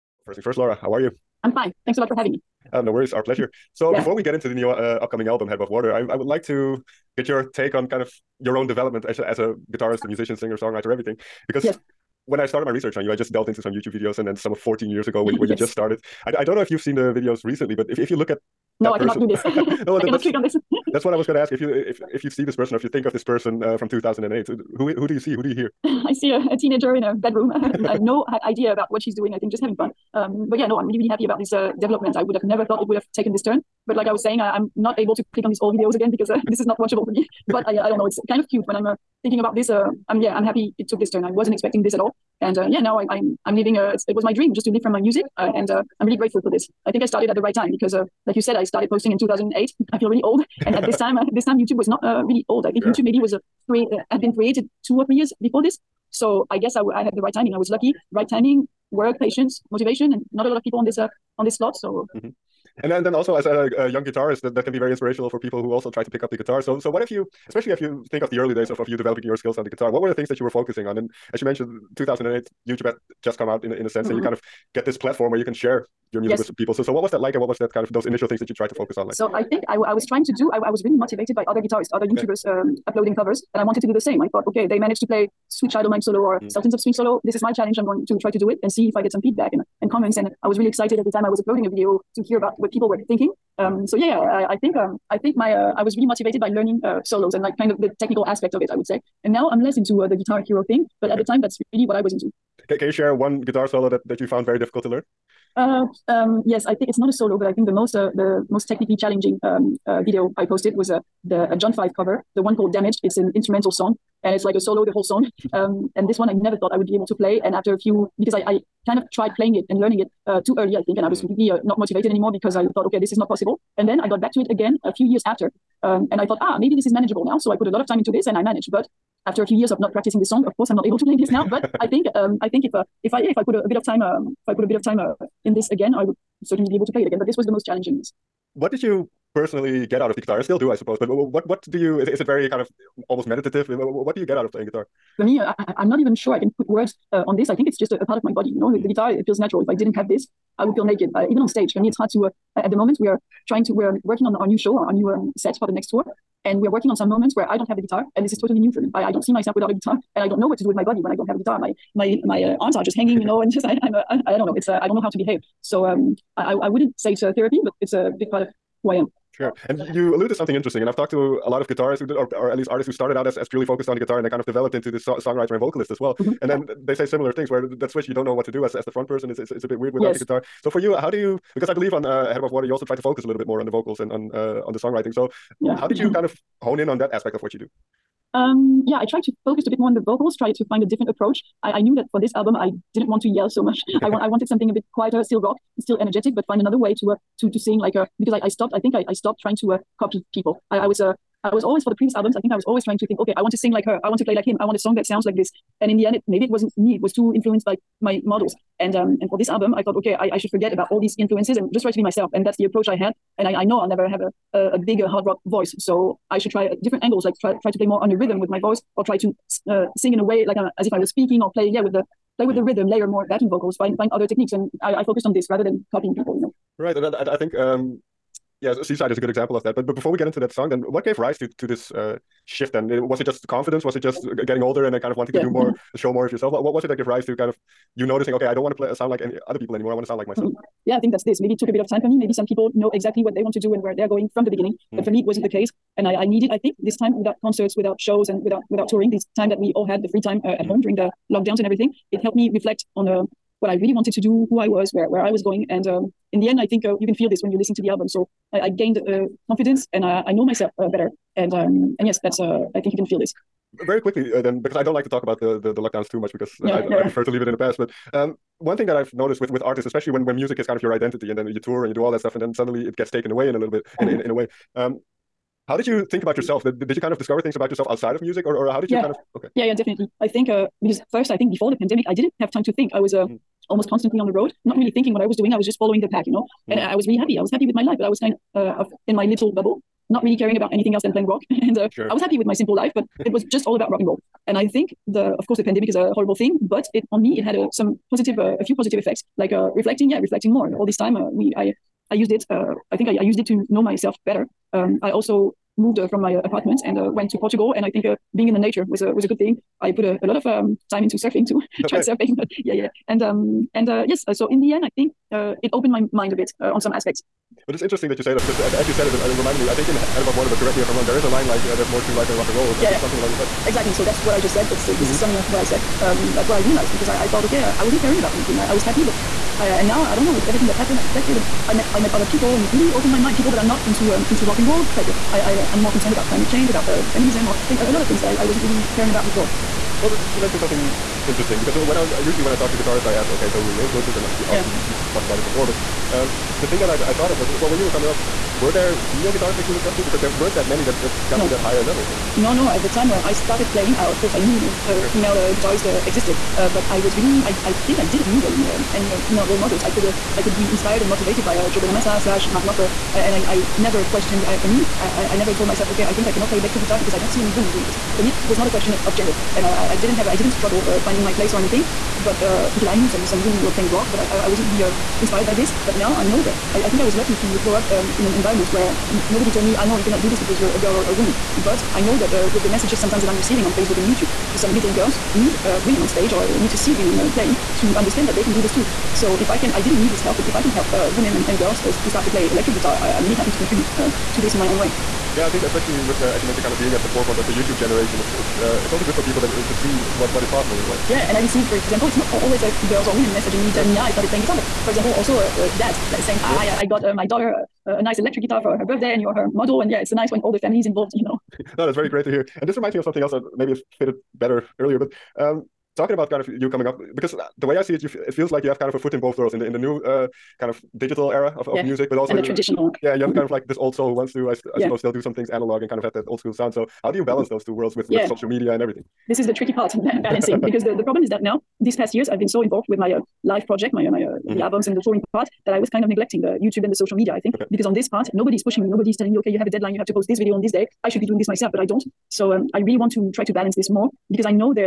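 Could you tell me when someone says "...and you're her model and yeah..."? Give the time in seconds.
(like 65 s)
409 s.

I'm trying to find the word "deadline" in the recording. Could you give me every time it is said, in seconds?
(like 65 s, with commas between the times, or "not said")
439 s.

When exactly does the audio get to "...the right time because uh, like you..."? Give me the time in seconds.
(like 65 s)
47 s.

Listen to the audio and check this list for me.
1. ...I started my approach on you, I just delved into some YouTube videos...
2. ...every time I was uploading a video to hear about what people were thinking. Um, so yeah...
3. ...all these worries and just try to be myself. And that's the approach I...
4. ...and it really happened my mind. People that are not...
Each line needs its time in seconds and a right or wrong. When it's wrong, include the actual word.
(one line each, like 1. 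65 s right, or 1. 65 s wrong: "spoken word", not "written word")
1. 12 s wrong: "research", not "approach"
2. 90 s right
3. 210 s wrong: "influences", not "worries"
4. 332 s wrong: "opened", not "happened".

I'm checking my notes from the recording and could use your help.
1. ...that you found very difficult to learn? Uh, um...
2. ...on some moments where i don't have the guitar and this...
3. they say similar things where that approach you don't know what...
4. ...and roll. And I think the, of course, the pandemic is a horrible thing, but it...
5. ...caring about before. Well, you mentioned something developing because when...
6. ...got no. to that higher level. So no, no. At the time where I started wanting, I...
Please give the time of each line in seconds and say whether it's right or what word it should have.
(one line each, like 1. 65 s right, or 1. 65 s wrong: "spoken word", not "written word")
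1. 104 s right
2. 156 s right
3. 176 s wrong: "switch", not "approach"
4. 293 s right
5. 338 s wrong: "interesting", not "developing"
6. 351 s wrong: "playing", not "wanting".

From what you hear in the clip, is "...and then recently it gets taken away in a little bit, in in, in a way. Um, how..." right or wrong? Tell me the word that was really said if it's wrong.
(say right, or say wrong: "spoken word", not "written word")
wrong: "suddenly", not "recently".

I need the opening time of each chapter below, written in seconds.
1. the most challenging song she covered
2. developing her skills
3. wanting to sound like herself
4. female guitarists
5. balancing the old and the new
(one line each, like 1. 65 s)
1. 102 s
2. 62 s
3. 169 s
4. 339 s
5. 411 s.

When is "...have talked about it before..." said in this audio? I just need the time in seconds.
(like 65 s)
344 s.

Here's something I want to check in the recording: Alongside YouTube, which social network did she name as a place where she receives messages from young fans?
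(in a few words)
Facebook.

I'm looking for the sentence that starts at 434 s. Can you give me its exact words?
the albums and the touring part that I was kind of neglecting the YouTube and the social media, I think, okay.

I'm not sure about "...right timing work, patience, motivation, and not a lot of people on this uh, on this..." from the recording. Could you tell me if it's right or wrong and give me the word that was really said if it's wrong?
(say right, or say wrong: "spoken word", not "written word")
right.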